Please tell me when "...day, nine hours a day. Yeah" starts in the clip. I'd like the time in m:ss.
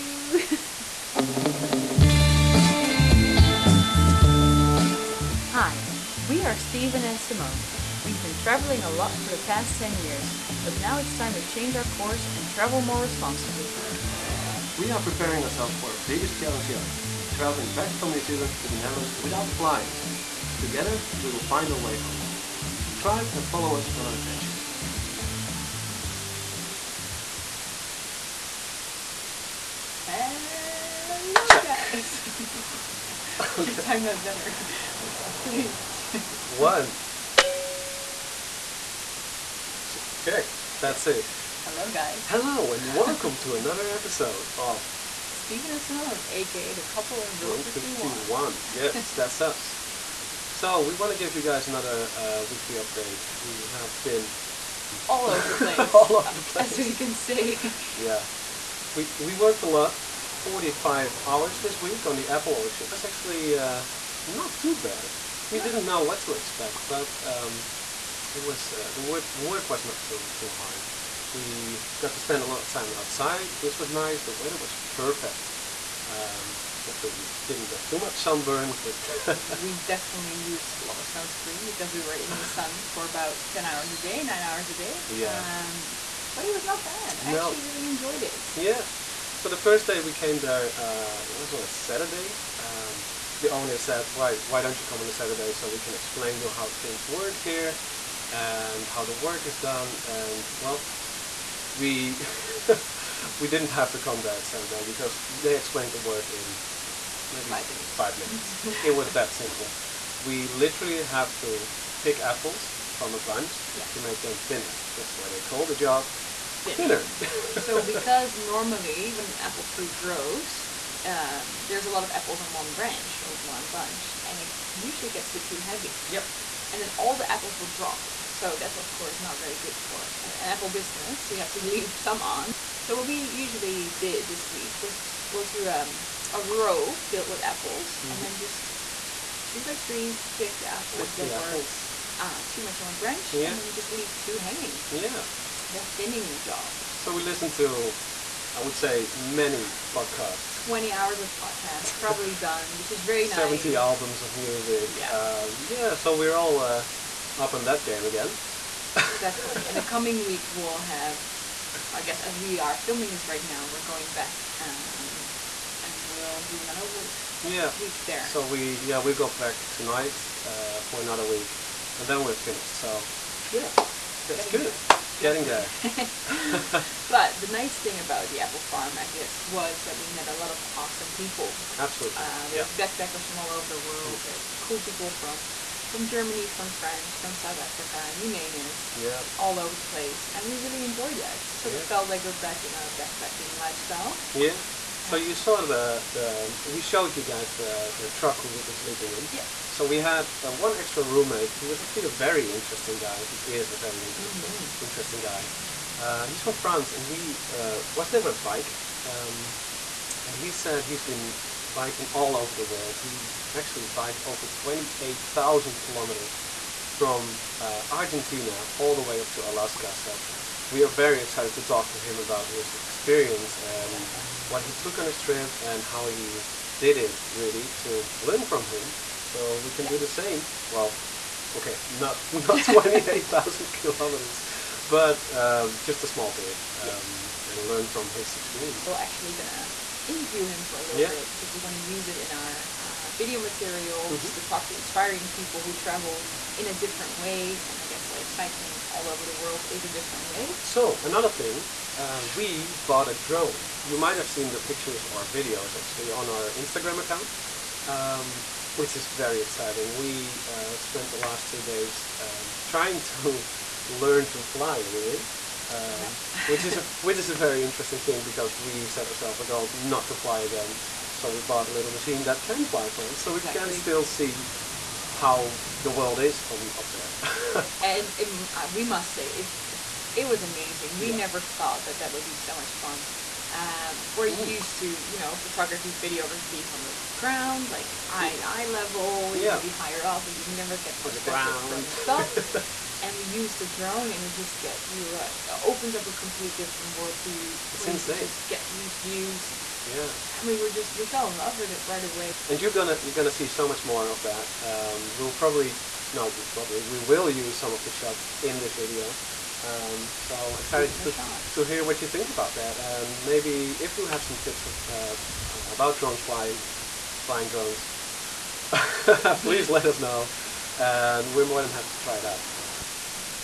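1:24.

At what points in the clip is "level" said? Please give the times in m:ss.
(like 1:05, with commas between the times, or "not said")
4:48.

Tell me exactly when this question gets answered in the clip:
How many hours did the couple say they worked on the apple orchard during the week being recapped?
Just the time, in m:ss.
1:00.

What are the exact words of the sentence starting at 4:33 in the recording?
we can still see how the world is from up there.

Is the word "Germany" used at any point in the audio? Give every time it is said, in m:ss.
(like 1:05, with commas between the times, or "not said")
3:06.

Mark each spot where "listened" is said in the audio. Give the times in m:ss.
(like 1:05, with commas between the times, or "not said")
2:27.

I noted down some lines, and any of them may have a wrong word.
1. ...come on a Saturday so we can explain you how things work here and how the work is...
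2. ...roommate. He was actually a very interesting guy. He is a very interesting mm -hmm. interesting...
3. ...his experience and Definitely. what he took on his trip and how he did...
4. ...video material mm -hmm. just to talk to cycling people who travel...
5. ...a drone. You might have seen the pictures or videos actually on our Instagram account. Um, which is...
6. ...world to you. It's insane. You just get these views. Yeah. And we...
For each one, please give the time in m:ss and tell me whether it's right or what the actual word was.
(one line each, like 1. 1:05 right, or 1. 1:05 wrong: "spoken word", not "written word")
1. 1:34 right
2. 3:21 right
3. 3:42 right
4. 4:03 wrong: "inspiring", not "cycling"
5. 4:13 right
6. 4:56 right.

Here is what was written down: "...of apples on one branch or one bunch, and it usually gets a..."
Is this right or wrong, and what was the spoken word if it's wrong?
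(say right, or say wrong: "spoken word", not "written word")
right.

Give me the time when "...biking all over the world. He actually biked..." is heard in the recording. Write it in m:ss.
3:31.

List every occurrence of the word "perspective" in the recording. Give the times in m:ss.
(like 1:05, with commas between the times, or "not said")
4:51.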